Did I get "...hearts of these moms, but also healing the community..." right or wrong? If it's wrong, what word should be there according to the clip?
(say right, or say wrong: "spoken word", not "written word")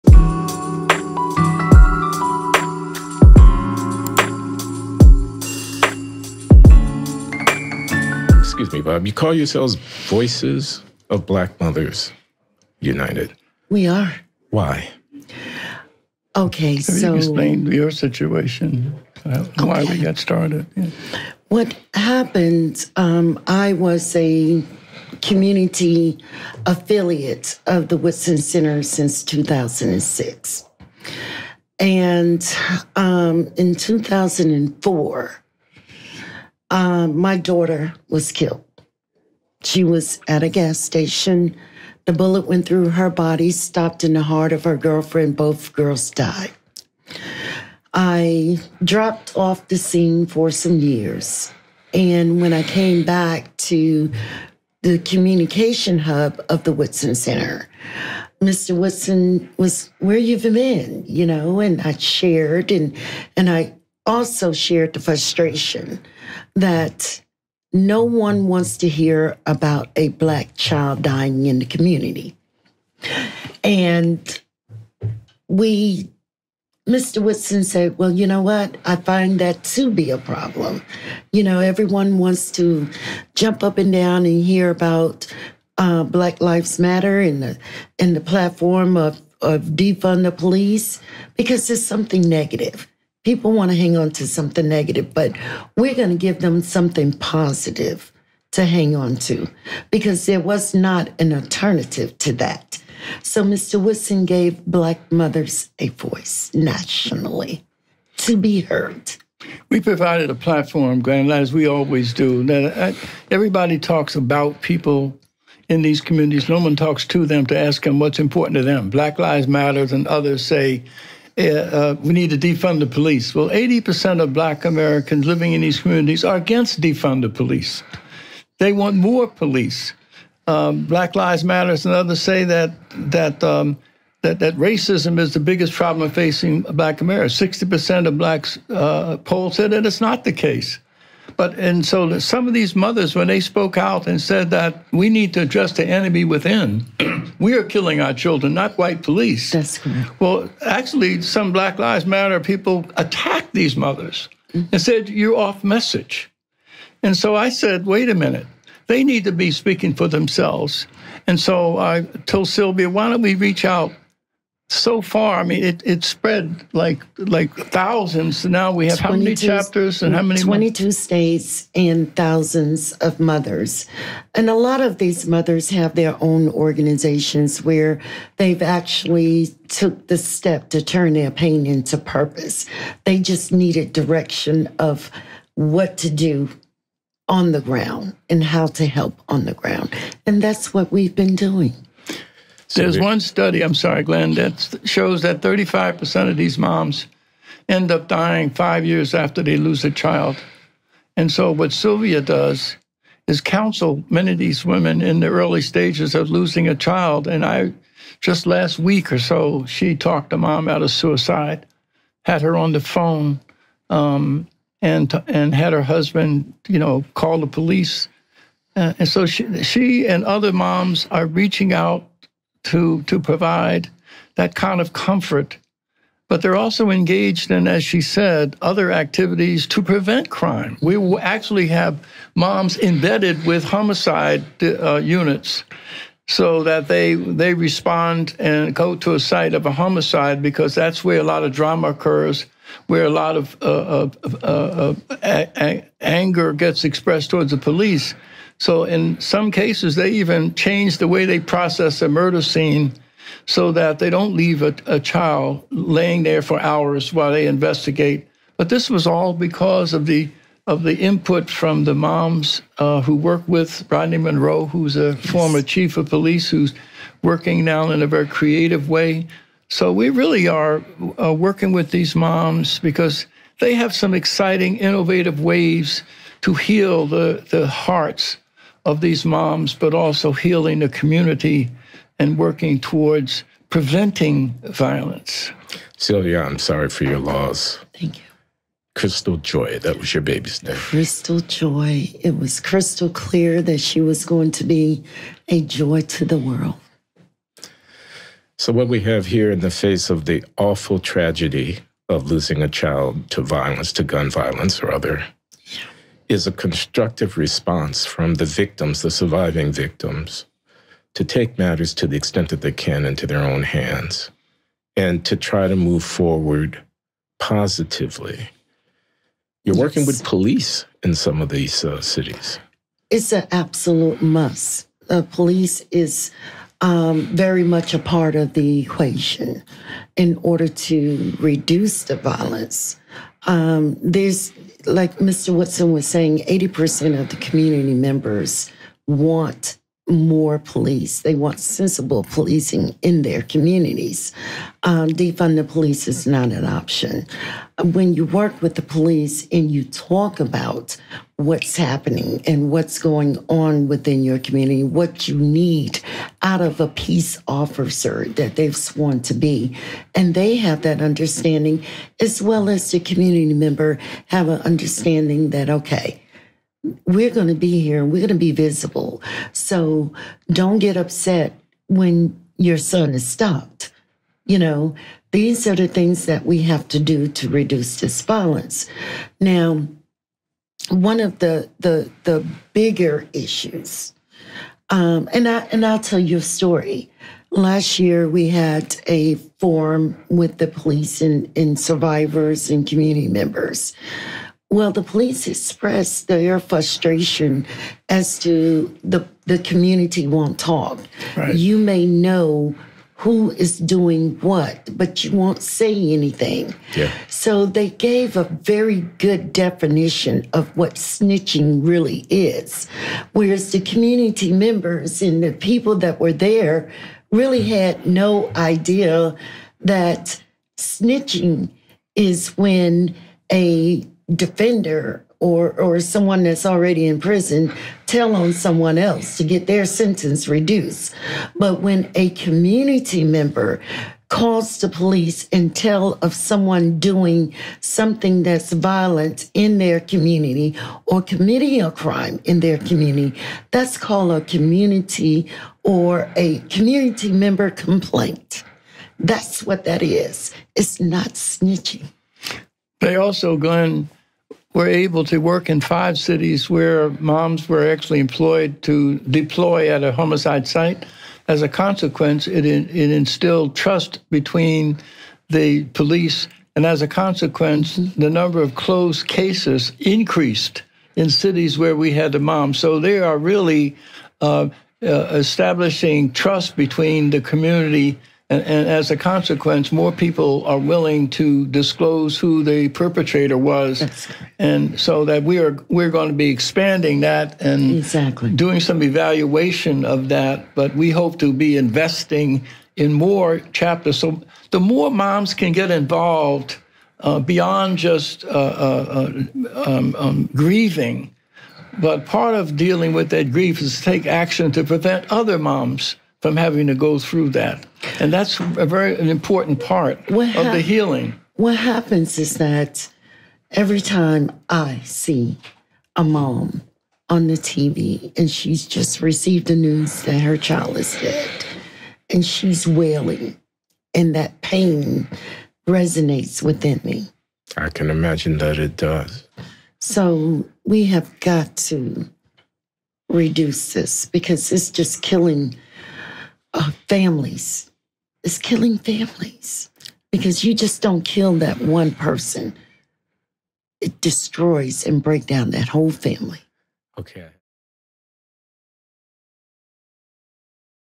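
right.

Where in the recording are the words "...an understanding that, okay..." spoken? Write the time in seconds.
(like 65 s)
364 s.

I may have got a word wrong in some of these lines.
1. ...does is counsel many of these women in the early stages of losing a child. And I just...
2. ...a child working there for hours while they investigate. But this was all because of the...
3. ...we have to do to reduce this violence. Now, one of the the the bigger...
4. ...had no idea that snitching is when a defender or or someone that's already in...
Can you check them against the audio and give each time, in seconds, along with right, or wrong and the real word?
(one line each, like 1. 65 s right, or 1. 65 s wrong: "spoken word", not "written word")
1. 202 s right
2. 254 s wrong: "laying", not "working"
3. 376 s right
4. 417 s right.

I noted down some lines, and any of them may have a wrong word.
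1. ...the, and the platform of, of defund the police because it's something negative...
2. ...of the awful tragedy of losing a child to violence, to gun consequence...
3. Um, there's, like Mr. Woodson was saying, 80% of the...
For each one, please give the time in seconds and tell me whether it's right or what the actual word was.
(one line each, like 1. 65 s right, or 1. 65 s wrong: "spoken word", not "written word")
1. 87 s right
2. 300 s wrong: "violence", not "consequence"
3. 333 s right.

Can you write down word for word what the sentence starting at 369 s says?
So don't get upset when your son is stopped.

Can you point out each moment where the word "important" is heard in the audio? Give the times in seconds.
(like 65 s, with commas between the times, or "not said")
118 s, 509 s.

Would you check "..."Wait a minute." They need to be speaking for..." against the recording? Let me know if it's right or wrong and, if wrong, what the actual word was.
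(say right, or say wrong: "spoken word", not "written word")
right.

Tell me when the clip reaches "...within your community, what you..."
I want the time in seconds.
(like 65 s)
353 s.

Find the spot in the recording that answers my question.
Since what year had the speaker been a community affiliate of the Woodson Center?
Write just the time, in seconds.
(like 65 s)
29 s.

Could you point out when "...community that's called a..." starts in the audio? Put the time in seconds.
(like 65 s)
442 s.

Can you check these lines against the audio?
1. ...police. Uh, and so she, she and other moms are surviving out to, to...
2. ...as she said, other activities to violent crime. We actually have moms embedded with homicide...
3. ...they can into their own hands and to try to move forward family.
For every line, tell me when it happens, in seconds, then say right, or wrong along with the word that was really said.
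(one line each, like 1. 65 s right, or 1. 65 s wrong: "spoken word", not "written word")
1. 217 s wrong: "reaching", not "surviving"
2. 227 s wrong: "prevent", not "violent"
3. 312 s wrong: "positively", not "family".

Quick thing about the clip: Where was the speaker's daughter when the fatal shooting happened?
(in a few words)
a gas station.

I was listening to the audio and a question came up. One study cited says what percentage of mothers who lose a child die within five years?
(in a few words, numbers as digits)
35%.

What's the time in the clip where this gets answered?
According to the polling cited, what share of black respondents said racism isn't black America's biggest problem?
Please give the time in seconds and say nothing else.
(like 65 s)
137 s.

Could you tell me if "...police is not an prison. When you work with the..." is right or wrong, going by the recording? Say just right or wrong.
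wrong.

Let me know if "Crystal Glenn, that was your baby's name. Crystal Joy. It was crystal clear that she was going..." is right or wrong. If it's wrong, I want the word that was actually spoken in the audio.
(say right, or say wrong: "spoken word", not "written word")
wrong: "Joy", not "Glenn".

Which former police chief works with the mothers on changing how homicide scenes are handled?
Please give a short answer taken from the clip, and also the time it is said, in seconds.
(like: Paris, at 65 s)
Rodney Monroe, at 263 s.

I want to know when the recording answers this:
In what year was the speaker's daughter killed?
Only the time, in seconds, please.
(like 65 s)
33 s.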